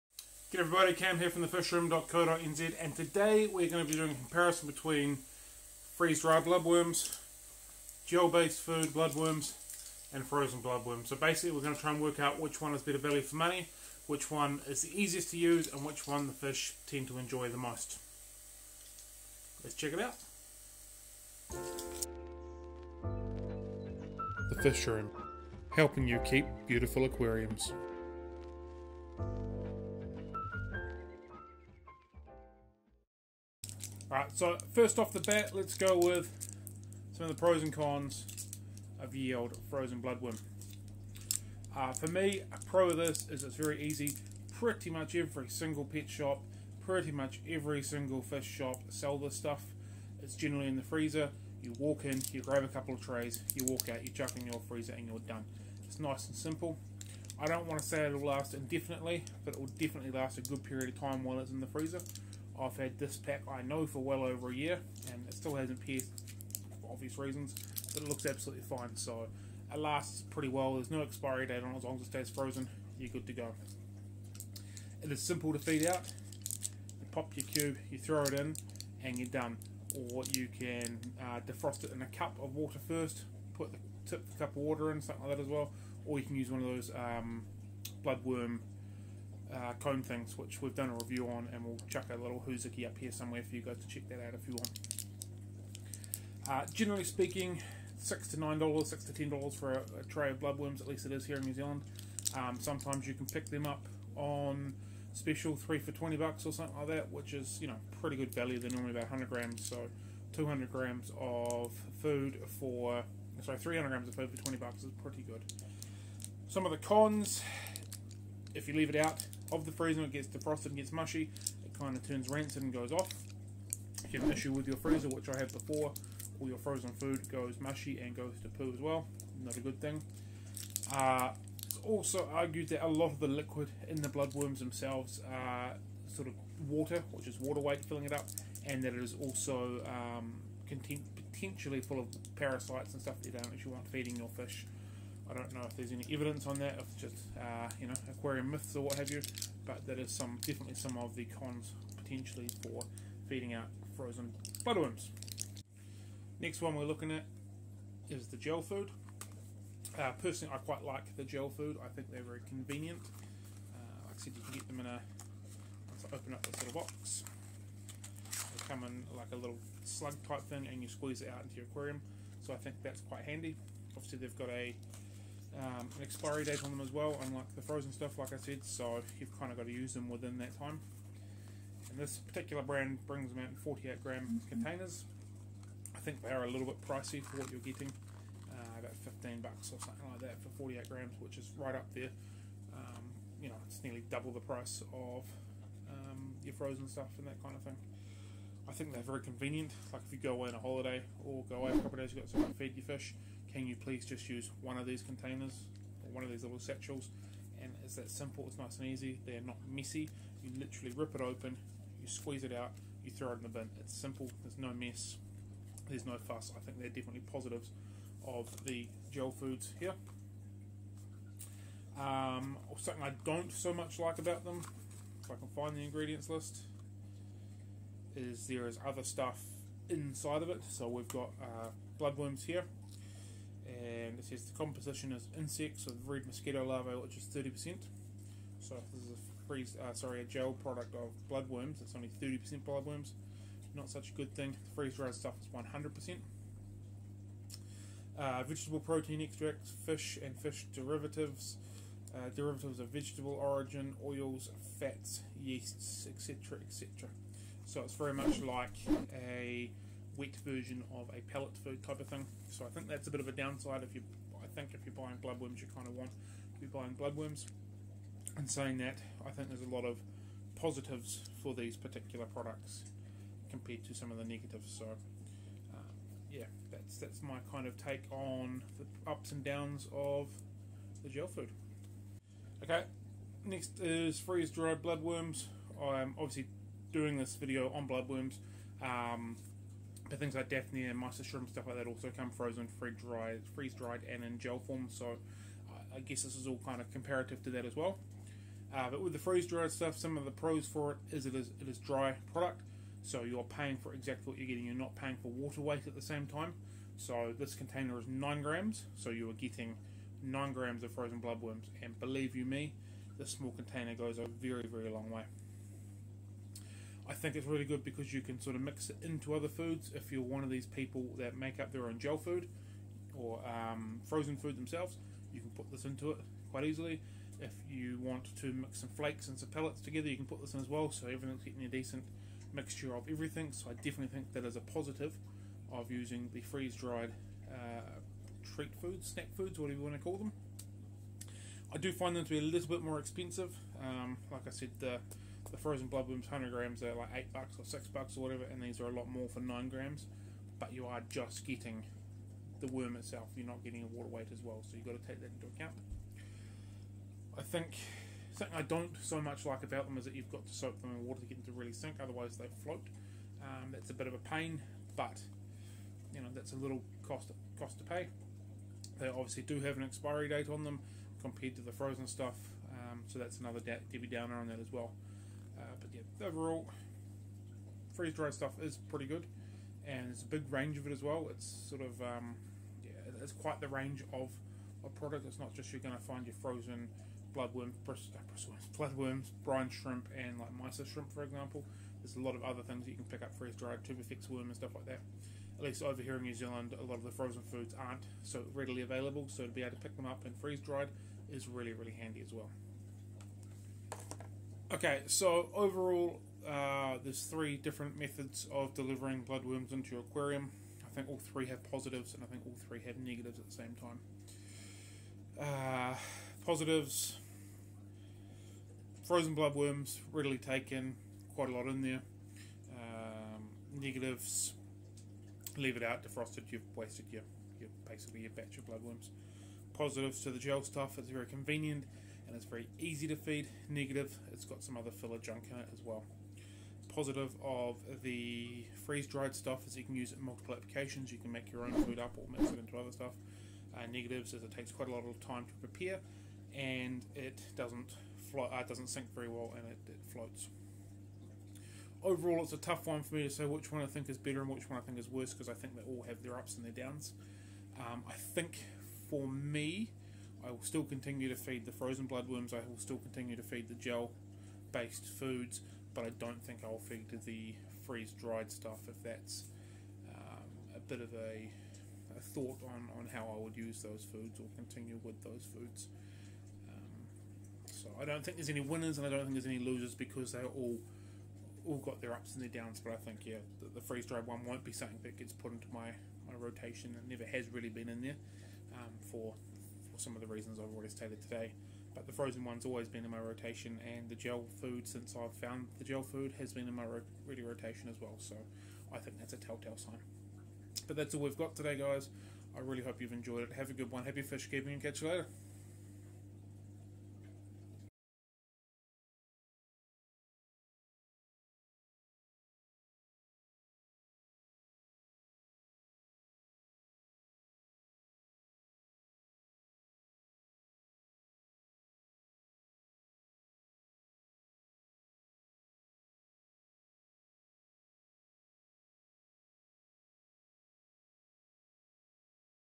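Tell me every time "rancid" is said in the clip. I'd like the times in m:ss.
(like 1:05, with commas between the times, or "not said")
2:02.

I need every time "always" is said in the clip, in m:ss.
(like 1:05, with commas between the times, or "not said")
8:12.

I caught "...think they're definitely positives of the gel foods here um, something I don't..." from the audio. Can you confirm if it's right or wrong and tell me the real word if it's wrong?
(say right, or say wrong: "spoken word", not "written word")
right.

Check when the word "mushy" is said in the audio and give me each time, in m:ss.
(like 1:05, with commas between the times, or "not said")
2:00, 2:07.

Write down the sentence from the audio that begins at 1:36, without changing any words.
Uh, generally speaking, six to nine dollars, six to ten dollars for a, a, tray of bloodworms.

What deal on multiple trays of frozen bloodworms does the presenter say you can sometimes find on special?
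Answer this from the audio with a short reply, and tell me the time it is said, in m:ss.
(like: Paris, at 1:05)
3 for $20, at 1:45.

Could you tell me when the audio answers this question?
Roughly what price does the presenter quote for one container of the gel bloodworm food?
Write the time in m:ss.
3:09.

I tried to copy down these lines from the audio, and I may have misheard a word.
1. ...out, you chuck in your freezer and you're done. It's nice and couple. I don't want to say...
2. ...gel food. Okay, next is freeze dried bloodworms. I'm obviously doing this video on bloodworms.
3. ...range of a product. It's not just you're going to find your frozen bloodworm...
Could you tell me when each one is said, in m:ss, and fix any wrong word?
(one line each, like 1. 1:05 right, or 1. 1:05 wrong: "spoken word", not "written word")
1. 0:53 wrong: "simple", not "couple"
2. 4:41 right
3. 6:23 right.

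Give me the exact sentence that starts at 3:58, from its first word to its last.
So if this is a freeze, uh, sorry, a gel product of bloodworms, it's only 30% bloodworms.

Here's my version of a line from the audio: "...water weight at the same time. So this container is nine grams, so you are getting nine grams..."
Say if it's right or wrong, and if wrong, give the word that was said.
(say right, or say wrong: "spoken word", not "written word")
right.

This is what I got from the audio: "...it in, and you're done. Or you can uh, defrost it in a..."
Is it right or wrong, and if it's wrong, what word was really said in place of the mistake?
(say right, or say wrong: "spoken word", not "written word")
right.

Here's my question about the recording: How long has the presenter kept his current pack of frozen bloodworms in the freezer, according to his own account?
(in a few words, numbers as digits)
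over a year.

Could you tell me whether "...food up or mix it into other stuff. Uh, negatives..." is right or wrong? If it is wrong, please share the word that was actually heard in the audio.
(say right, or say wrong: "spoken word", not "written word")
right.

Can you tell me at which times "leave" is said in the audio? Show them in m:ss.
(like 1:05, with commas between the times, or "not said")
1:58, 7:05.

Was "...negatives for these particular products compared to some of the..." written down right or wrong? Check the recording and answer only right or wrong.
wrong.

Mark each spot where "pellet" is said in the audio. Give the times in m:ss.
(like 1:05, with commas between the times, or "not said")
4:21, 5:29.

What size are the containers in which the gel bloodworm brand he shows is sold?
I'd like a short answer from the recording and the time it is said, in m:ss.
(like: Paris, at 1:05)
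48 grams, at 3:03.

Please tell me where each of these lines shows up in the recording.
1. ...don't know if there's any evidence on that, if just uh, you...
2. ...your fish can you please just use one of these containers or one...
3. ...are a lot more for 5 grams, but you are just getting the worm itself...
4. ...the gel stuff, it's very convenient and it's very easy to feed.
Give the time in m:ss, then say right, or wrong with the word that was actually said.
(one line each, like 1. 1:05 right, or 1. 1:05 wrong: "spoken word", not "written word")
1. 2:25 right
2. 3:22 right
3. 5:48 wrong: "9", not "5"
4. 7:10 right.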